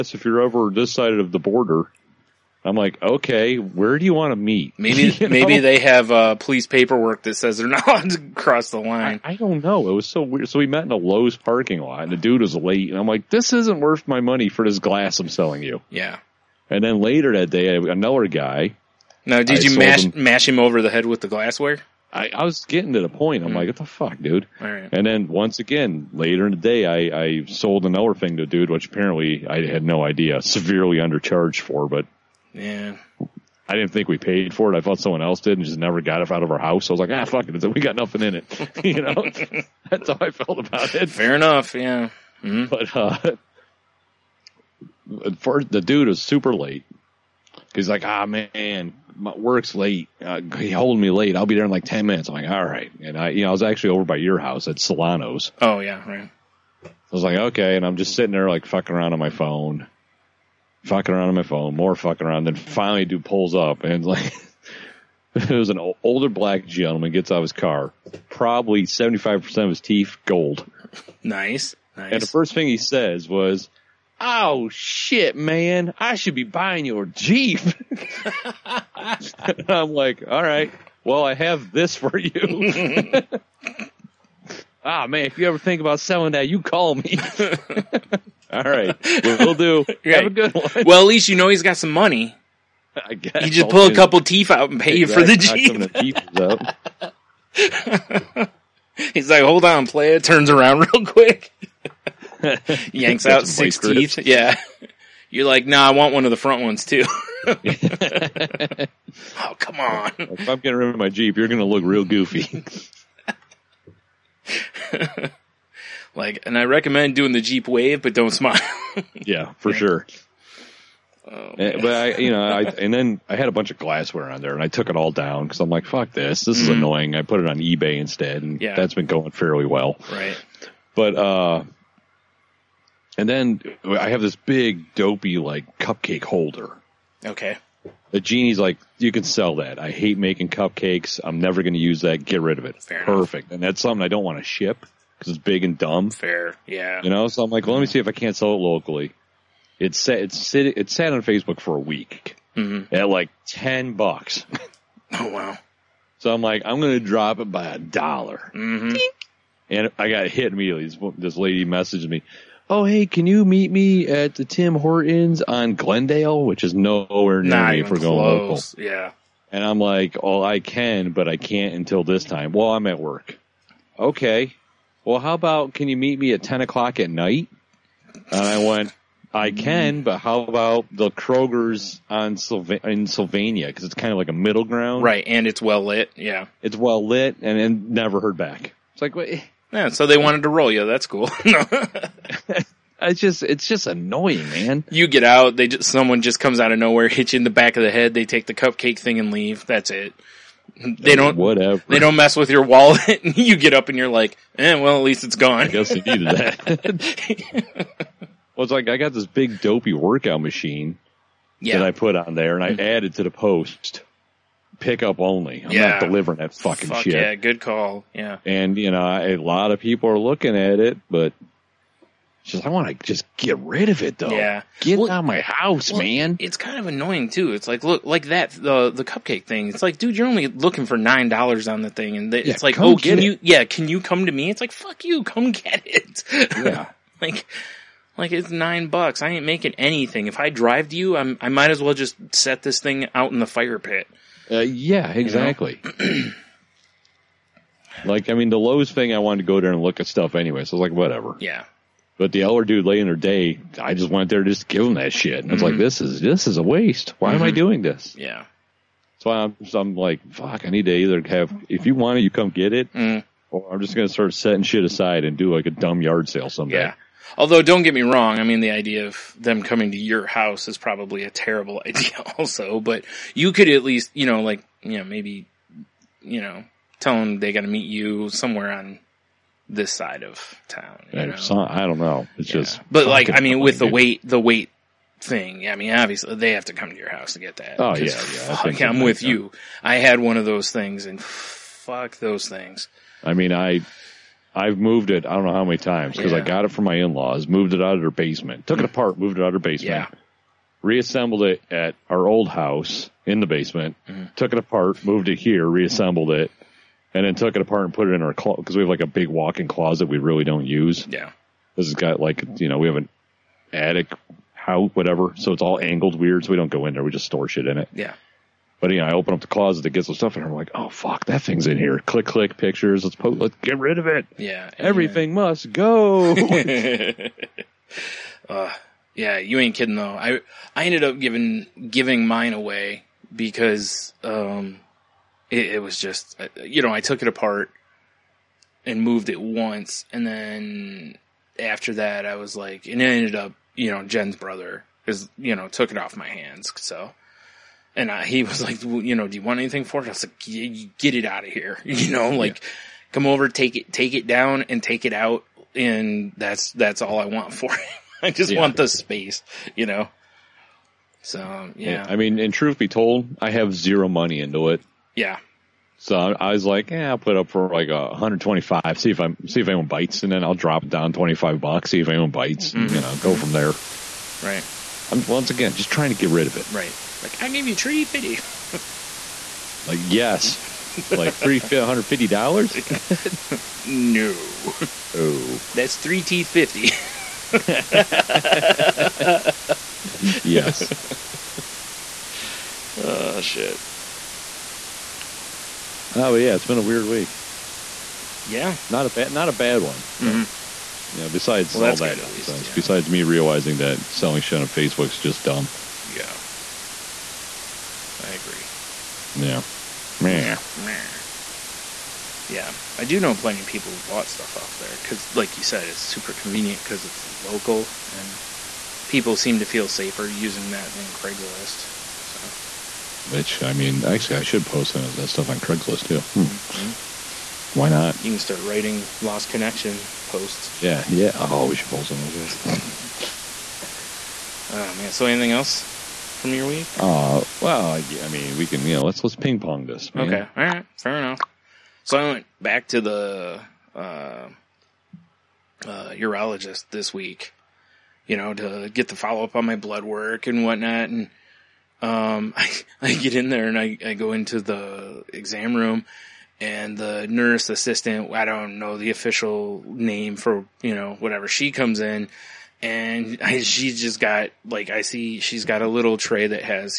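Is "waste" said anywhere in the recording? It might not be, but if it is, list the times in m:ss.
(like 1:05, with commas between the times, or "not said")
4:16.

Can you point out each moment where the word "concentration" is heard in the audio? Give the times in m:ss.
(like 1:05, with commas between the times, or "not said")
not said.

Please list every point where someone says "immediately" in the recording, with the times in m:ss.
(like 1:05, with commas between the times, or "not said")
2:40.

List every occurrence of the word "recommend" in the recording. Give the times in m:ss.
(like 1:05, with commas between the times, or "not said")
1:56.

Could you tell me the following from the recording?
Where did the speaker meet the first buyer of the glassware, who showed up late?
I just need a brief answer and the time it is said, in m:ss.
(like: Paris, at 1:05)
Lowe's parking lot, at 0:10.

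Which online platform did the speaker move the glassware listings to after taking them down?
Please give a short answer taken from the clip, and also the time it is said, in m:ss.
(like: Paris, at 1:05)
eBay, at 2:07.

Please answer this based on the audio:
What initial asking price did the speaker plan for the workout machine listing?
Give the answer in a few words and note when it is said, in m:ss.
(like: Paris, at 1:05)
$125, at 6:08.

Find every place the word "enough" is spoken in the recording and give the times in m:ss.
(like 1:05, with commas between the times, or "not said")
0:41, 2:23, 7:21.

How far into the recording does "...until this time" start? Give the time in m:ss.
2:51.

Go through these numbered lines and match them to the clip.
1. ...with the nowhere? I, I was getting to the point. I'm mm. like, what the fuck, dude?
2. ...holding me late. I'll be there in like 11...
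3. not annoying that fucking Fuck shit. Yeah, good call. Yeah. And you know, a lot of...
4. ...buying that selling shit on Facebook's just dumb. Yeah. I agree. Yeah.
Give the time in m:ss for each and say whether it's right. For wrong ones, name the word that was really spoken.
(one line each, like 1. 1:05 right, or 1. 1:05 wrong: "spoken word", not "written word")
1. 0:21 wrong: "glassware", not "nowhere"
2. 0:50 wrong: "10", not "11"
3. 3:35 wrong: "delivering", not "annoying"
4. 6:43 wrong: "realizing", not "buying".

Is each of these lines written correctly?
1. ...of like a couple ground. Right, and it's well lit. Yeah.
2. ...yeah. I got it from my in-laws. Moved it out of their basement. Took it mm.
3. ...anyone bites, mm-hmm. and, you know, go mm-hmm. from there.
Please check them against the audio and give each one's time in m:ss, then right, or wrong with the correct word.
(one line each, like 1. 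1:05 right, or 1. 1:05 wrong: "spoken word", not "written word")
1. 3:04 wrong: "middle", not "couple"
2. 4:56 right
3. 6:12 right.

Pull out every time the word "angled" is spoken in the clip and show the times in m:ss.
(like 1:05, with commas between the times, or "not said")
5:15.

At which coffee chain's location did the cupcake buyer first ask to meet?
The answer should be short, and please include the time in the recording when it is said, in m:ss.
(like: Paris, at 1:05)
Tim Hortons, at 2:44.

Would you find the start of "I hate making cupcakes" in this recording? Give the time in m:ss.
2:19.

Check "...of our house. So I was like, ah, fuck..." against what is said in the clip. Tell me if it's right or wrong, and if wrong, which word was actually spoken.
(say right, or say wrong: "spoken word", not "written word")
right.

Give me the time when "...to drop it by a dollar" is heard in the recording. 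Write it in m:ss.
2:36.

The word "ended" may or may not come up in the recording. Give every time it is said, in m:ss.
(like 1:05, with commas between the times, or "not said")
5:30, 5:43.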